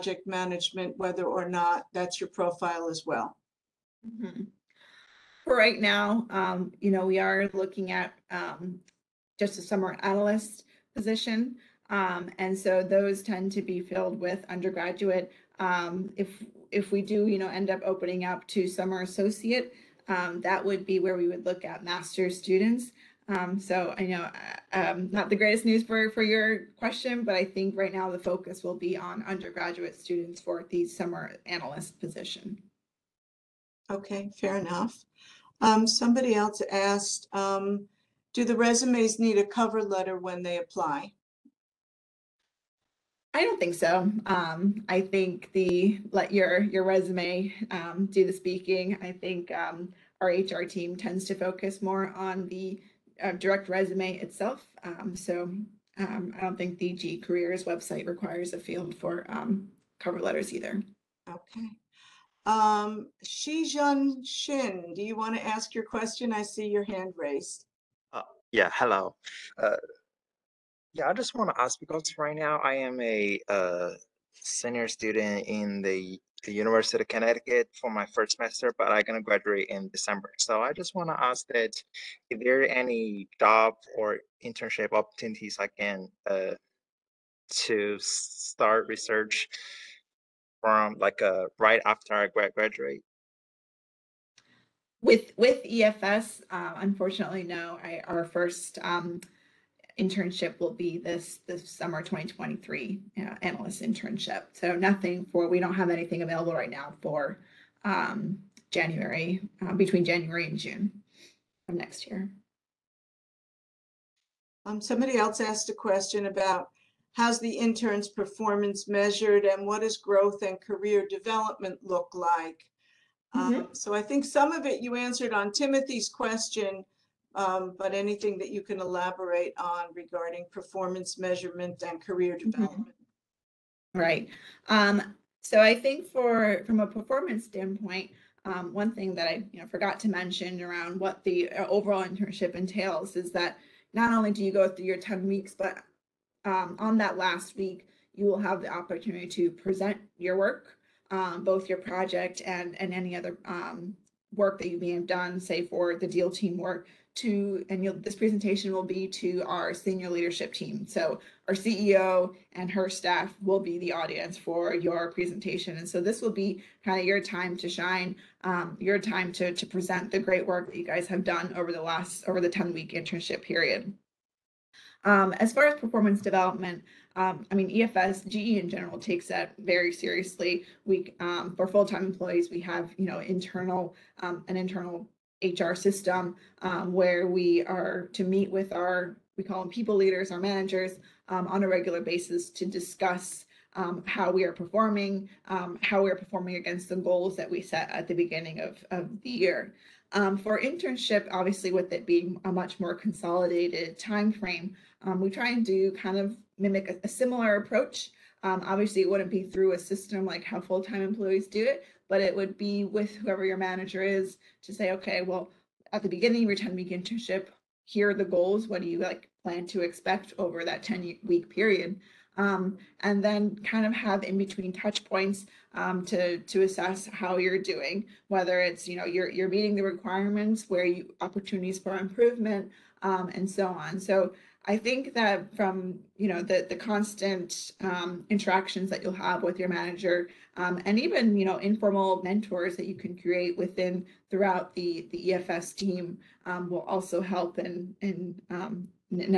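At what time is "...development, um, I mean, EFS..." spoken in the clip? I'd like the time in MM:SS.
02:56.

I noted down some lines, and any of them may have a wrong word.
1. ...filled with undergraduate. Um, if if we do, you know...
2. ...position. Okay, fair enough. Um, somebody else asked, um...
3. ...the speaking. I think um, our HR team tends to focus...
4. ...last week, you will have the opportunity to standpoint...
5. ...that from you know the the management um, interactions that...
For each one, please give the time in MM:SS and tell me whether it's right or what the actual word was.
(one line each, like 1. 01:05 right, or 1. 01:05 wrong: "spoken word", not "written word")
1. 00:13 right
2. 00:31 right
3. 00:48 right
4. 02:27 wrong: "present", not "standpoint"
5. 03:55 wrong: "constant", not "management".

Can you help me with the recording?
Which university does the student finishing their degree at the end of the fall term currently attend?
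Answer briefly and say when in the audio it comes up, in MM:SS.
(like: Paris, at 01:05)
University of Connecticut, at 01:16.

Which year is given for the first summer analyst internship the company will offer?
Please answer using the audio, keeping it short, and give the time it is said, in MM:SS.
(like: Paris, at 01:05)
2023, at 01:42.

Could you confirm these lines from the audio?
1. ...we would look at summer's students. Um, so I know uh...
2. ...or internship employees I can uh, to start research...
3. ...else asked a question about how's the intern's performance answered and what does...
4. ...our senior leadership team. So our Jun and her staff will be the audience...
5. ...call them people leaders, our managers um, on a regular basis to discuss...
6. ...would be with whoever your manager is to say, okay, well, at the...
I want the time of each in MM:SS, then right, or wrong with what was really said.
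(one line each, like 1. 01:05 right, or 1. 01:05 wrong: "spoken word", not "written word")
1. 00:21 wrong: "master", not "summer"
2. 01:23 wrong: "opportunities", not "employees"
3. 01:55 wrong: "measured", not "answered"
4. 02:39 wrong: "CEO", not "Jun"
5. 03:09 right
6. 03:32 right.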